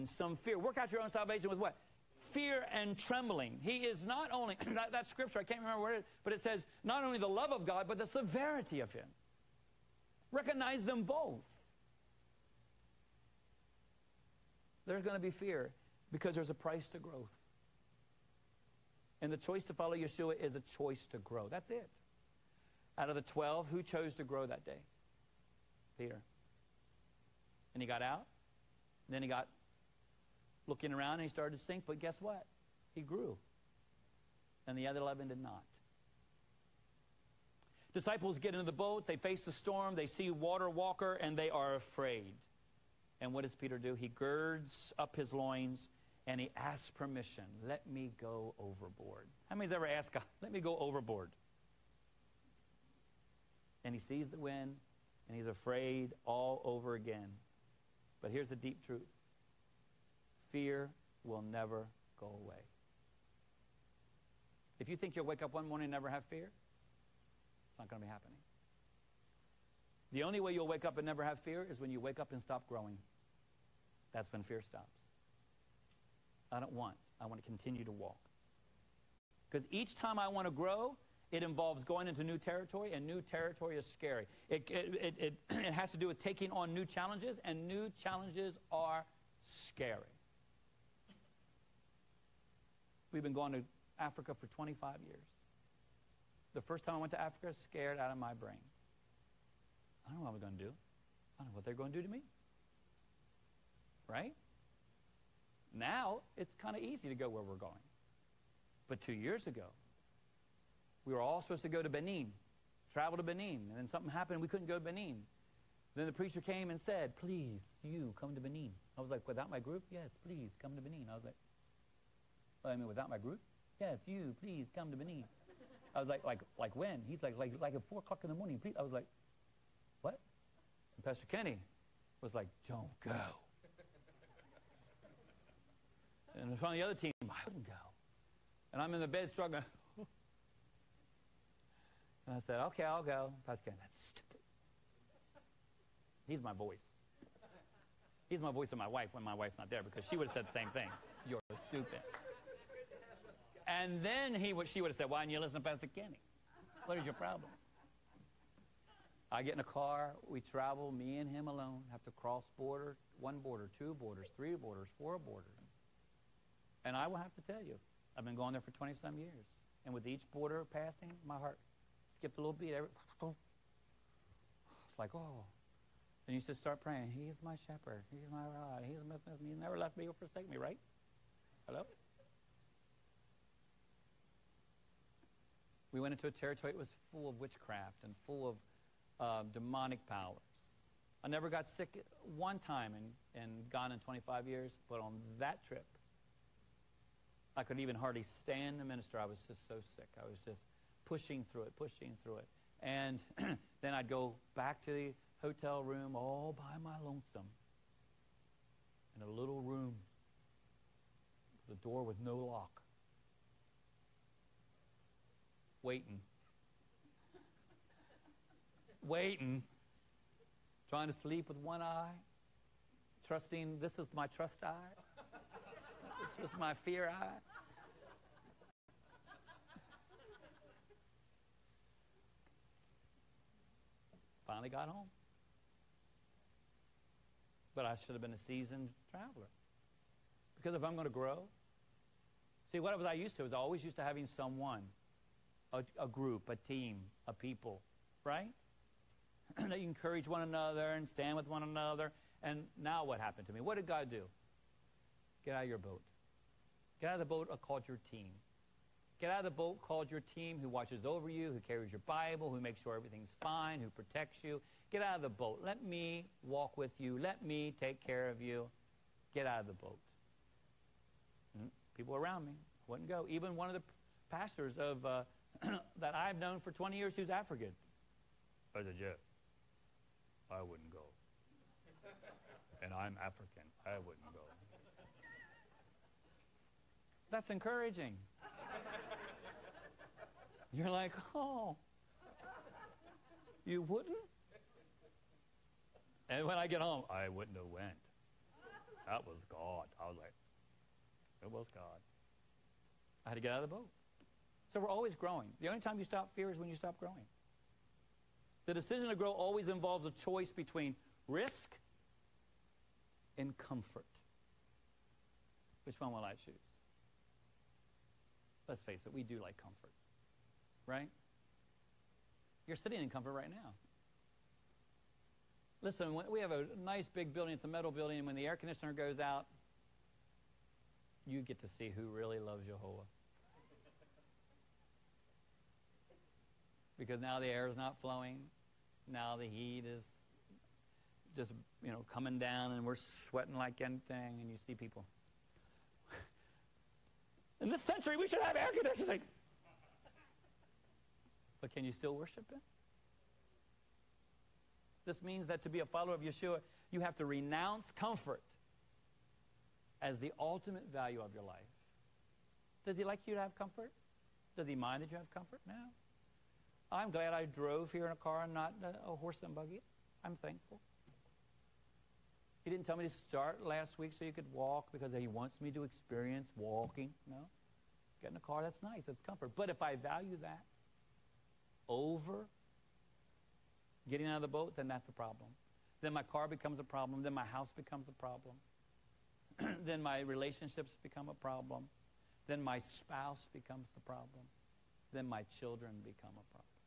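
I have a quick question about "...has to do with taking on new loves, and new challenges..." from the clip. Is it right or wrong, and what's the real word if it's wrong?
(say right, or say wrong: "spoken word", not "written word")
wrong: "challenges", not "loves".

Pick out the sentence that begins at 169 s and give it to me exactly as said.
And with each border passing, my heart skipped a little beat.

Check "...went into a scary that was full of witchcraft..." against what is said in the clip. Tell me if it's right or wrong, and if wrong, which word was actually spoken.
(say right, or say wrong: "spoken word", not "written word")
wrong: "territory", not "scary".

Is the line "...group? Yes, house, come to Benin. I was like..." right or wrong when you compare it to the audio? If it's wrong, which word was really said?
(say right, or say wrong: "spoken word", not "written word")
wrong: "please", not "house".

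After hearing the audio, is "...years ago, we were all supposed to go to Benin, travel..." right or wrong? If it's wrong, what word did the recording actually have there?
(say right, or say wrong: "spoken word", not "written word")
right.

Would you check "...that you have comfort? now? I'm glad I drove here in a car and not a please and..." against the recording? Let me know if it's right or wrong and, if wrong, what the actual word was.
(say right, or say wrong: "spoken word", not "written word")
wrong: "horse", not "please".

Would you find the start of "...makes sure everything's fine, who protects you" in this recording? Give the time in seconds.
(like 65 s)
262 s.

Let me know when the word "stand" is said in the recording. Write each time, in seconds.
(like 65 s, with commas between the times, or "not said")
198 s, 251 s.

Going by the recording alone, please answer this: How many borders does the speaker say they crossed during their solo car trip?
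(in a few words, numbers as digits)
4.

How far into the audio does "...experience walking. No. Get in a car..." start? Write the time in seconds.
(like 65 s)
375 s.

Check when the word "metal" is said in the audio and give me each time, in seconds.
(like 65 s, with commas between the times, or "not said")
327 s.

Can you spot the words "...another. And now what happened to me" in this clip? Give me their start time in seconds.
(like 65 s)
251 s.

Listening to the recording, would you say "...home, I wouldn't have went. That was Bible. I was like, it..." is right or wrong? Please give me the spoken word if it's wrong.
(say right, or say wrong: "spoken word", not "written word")
wrong: "God", not "Bible".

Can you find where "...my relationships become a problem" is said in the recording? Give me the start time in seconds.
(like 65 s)
390 s.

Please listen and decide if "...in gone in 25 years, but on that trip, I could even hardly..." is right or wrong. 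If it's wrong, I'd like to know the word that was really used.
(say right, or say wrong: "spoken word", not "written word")
right.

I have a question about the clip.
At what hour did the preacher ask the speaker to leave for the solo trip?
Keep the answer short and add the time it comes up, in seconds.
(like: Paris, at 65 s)
4 o'clock in the morning, at 127 s.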